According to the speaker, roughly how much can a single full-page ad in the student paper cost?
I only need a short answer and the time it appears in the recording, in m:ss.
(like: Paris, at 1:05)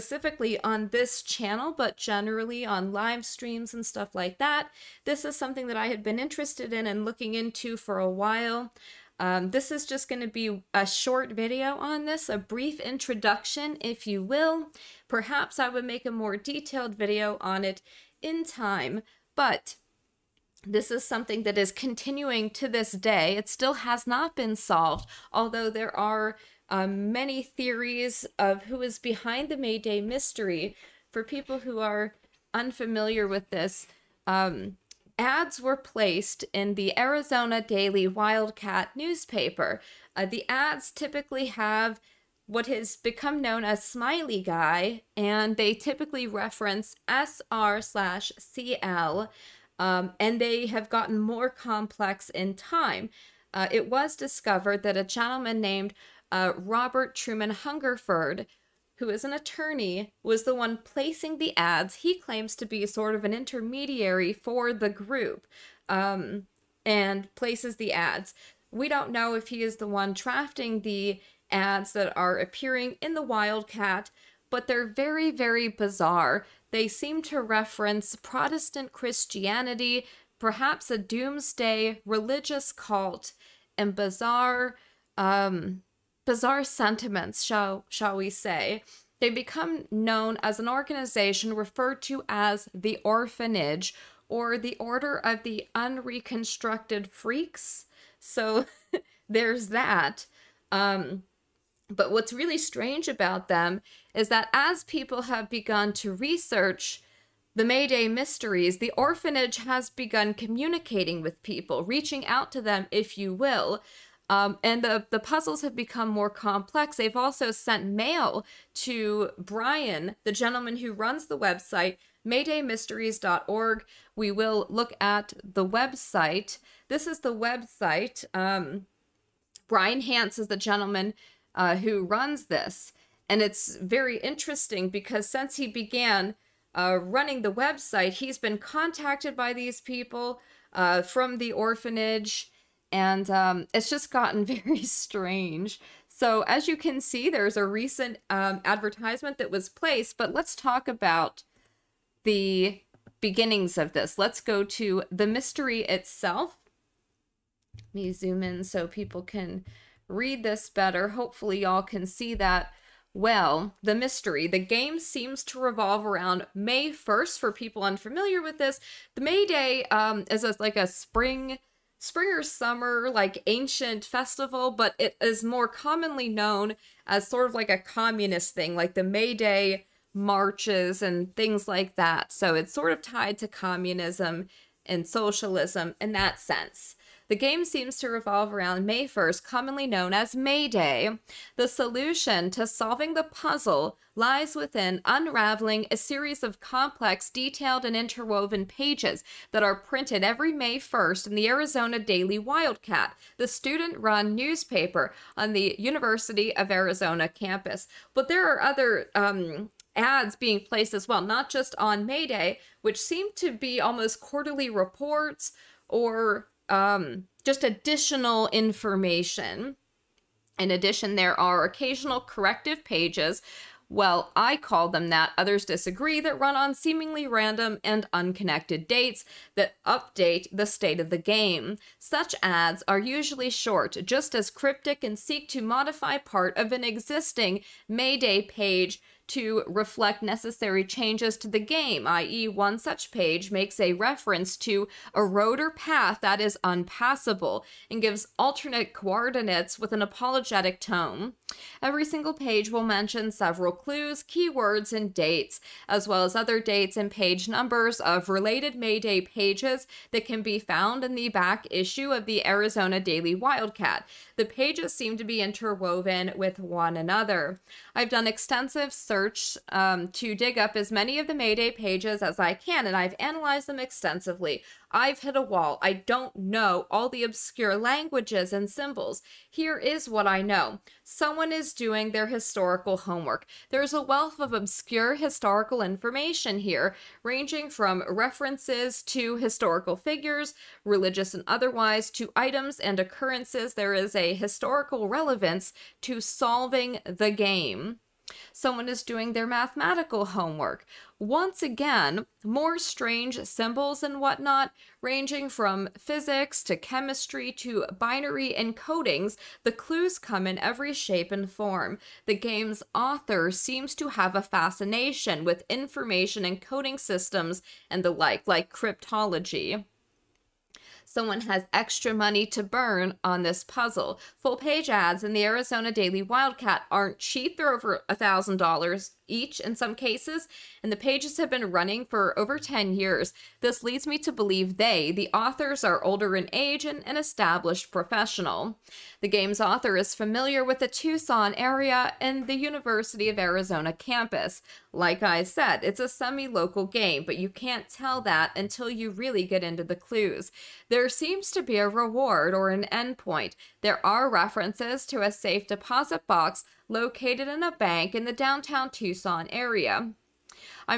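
over $1,000, at 5:27.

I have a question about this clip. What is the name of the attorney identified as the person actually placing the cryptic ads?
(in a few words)
Robert Truman Hungerford.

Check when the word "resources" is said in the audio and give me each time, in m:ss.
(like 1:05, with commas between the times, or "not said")
not said.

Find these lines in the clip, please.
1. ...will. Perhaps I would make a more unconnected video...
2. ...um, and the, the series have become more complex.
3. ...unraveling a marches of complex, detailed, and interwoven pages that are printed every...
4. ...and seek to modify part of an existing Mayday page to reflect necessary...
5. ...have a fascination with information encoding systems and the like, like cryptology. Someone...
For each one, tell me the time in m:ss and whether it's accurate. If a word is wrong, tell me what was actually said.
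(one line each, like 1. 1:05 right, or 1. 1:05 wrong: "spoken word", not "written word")
1. 0:14 wrong: "detailed", not "unconnected"
2. 1:54 wrong: "puzzles", not "series"
3. 3:15 wrong: "series", not "marches"
4. 3:55 right
5. 5:14 right.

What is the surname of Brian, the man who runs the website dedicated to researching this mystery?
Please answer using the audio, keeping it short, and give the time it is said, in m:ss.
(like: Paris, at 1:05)
Hance, at 2:09.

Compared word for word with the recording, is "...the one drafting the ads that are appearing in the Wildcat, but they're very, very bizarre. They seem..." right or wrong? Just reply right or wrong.
right.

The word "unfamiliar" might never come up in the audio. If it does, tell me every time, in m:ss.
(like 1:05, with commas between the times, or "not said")
0:32, 2:47.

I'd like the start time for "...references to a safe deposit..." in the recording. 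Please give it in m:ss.
5:54.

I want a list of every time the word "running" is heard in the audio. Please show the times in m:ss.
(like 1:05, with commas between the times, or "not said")
2:17, 5:31.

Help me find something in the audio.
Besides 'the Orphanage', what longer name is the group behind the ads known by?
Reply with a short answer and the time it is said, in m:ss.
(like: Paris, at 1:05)
Order of the Unreconstructed Freaks, at 1:34.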